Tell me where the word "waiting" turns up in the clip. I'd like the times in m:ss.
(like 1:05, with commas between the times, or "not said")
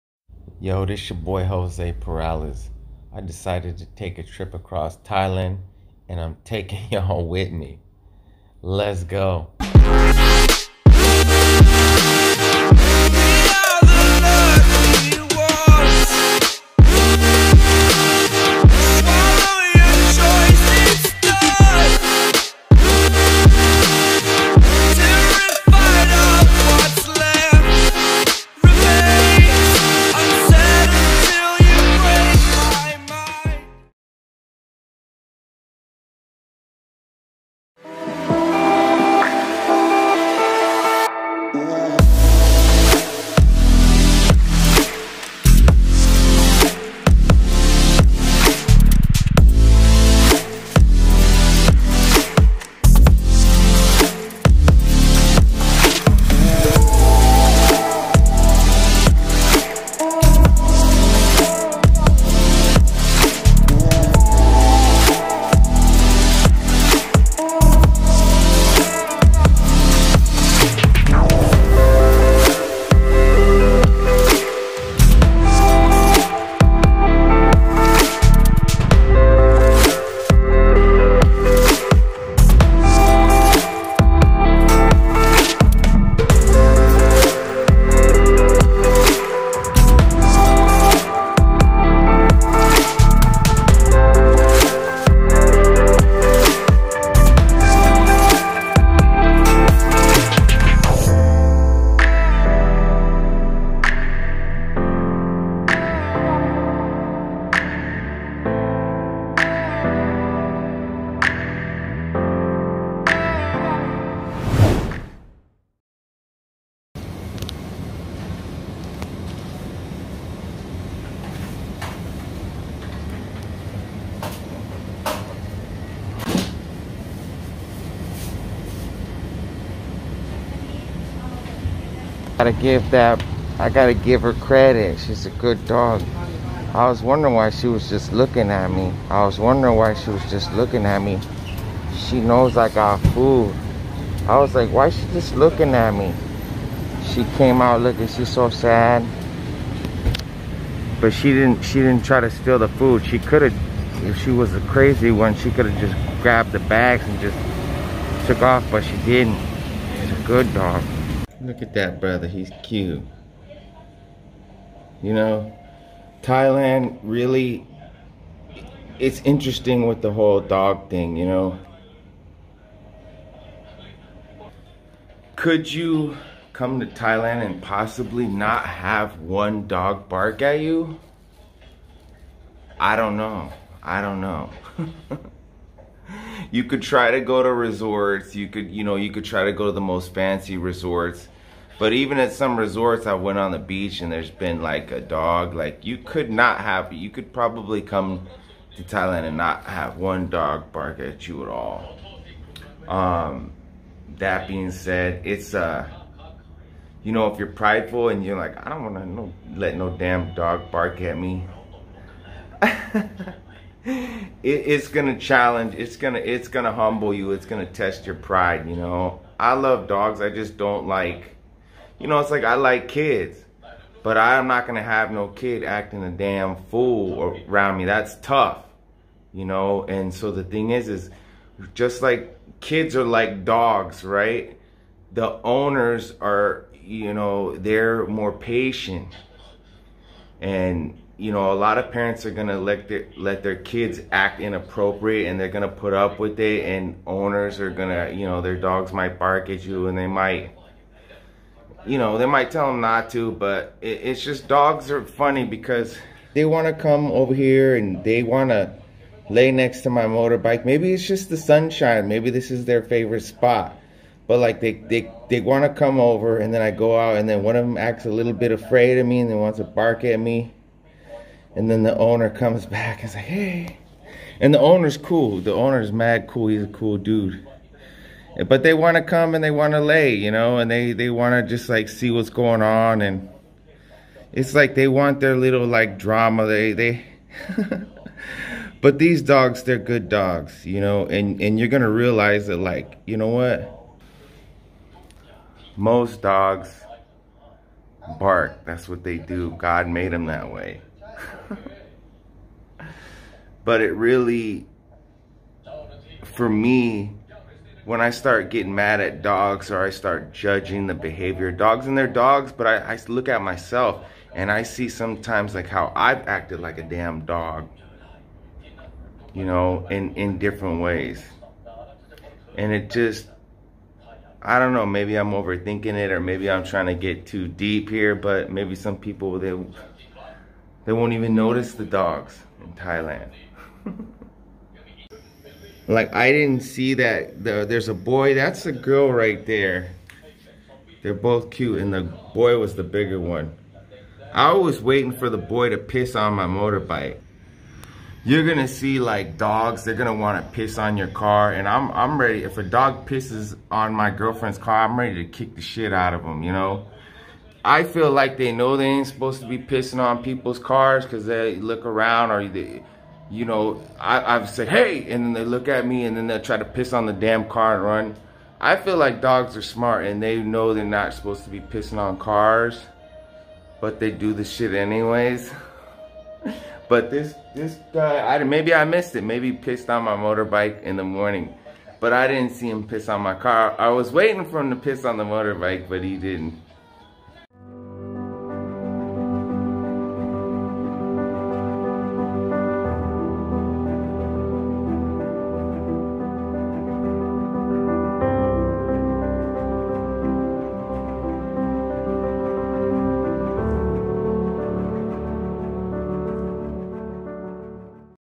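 5:44, 6:24.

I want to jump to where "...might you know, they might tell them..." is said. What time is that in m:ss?
4:10.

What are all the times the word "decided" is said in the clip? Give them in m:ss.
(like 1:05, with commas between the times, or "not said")
0:03.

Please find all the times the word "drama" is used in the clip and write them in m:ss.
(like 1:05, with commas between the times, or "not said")
4:45.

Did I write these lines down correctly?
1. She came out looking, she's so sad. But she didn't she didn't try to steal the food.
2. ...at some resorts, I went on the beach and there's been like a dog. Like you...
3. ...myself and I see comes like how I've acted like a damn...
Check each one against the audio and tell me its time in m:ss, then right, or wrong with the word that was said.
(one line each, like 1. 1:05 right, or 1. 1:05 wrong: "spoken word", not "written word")
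1. 2:27 right
2. 3:12 right
3. 5:13 wrong: "sometimes", not "comes".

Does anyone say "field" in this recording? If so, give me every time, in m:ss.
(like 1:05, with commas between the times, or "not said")
not said.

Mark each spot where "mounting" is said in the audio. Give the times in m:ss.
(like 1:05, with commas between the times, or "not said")
not said.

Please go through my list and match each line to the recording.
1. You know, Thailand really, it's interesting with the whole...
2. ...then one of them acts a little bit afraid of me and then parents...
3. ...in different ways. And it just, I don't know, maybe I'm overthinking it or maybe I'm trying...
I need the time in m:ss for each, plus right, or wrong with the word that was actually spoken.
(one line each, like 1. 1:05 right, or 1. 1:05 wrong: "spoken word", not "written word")
1. 2:45 right
2. 4:27 wrong: "wants", not "parents"
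3. 5:20 right.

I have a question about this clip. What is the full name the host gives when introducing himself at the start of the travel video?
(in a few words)
Jose Peralez.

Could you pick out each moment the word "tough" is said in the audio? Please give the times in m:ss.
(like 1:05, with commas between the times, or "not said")
3:48.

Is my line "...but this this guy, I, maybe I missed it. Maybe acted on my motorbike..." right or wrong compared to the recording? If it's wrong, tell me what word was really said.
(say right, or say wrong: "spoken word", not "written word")
wrong: "pissed", not "acted".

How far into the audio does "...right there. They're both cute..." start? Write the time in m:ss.
5:39.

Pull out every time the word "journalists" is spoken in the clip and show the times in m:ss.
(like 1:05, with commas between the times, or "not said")
not said.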